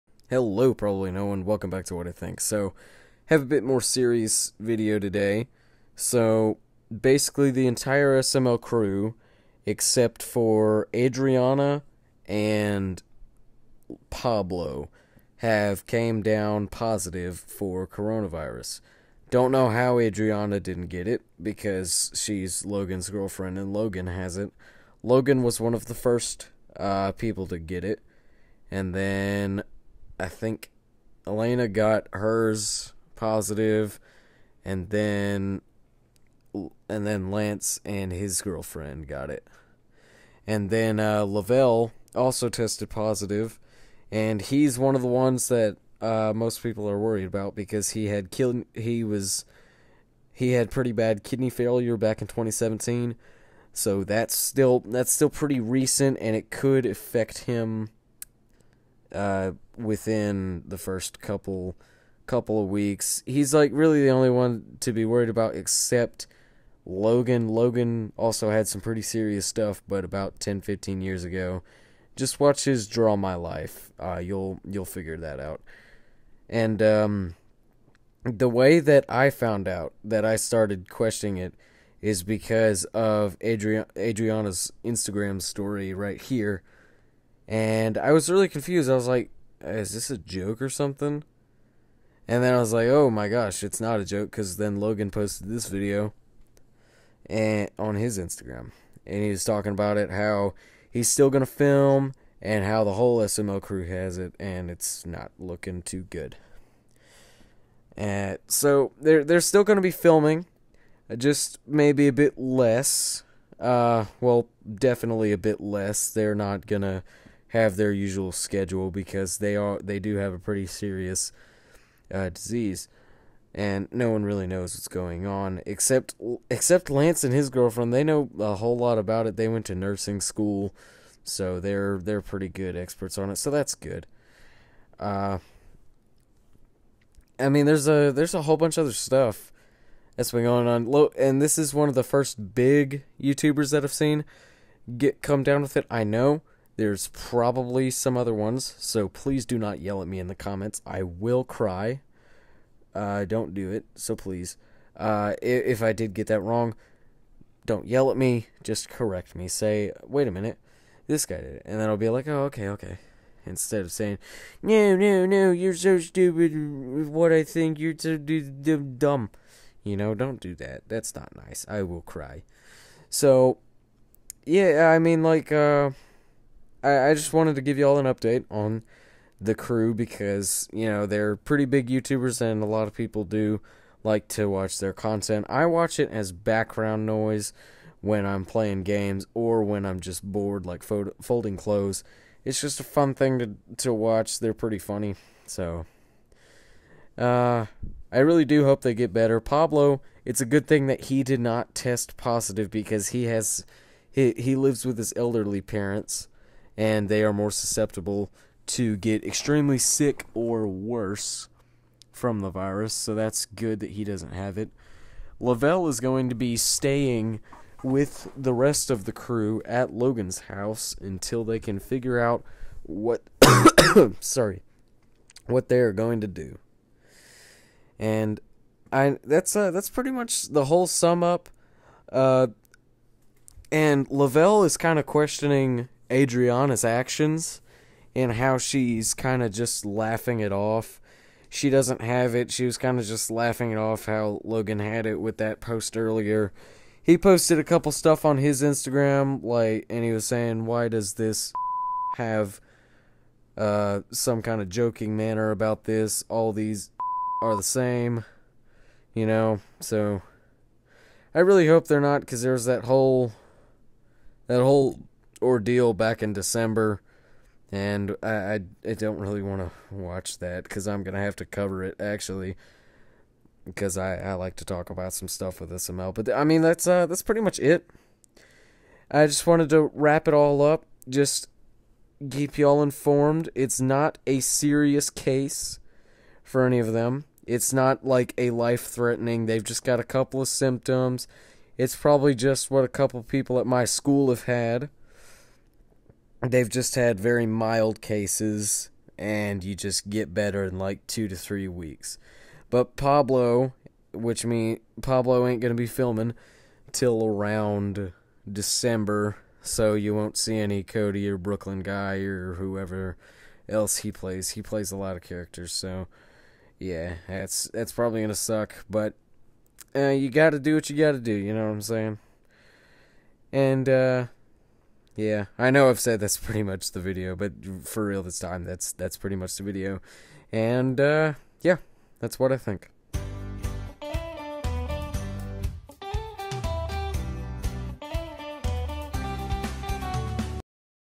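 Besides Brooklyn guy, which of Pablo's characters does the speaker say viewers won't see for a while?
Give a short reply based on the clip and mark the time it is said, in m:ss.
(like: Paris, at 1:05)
Cody, at 5:10.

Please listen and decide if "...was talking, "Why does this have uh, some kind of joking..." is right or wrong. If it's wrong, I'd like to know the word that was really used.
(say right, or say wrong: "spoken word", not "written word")
wrong: "saying", not "talking".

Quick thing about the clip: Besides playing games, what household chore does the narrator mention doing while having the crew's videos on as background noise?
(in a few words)
Folding clothes.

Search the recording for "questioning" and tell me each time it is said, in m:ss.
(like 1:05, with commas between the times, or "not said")
1:20, 3:55.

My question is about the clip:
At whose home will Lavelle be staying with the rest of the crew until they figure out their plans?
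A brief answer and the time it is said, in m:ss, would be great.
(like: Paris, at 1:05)
Logan's house, at 3:39.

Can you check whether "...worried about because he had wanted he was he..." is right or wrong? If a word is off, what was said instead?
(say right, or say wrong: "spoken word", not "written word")
wrong: "killed", not "wanted".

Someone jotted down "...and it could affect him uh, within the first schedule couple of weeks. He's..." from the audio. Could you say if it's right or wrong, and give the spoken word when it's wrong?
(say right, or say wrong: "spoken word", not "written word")
wrong: "couple", not "schedule".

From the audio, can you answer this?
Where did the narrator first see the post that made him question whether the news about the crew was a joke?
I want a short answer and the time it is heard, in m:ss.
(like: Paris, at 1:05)
Adriana's Instagram story, at 1:23.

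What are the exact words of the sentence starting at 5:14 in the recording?
He plays a lot of characters, so yeah, that's that's probably gonna suck.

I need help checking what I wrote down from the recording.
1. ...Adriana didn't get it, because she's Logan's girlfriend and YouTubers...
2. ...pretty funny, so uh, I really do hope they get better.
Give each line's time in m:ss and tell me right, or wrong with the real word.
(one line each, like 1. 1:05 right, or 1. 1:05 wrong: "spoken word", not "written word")
1. 0:19 wrong: "Logan", not "YouTubers"
2. 3:14 right.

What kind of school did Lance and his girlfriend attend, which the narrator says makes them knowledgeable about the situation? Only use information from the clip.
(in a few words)
Nursing school.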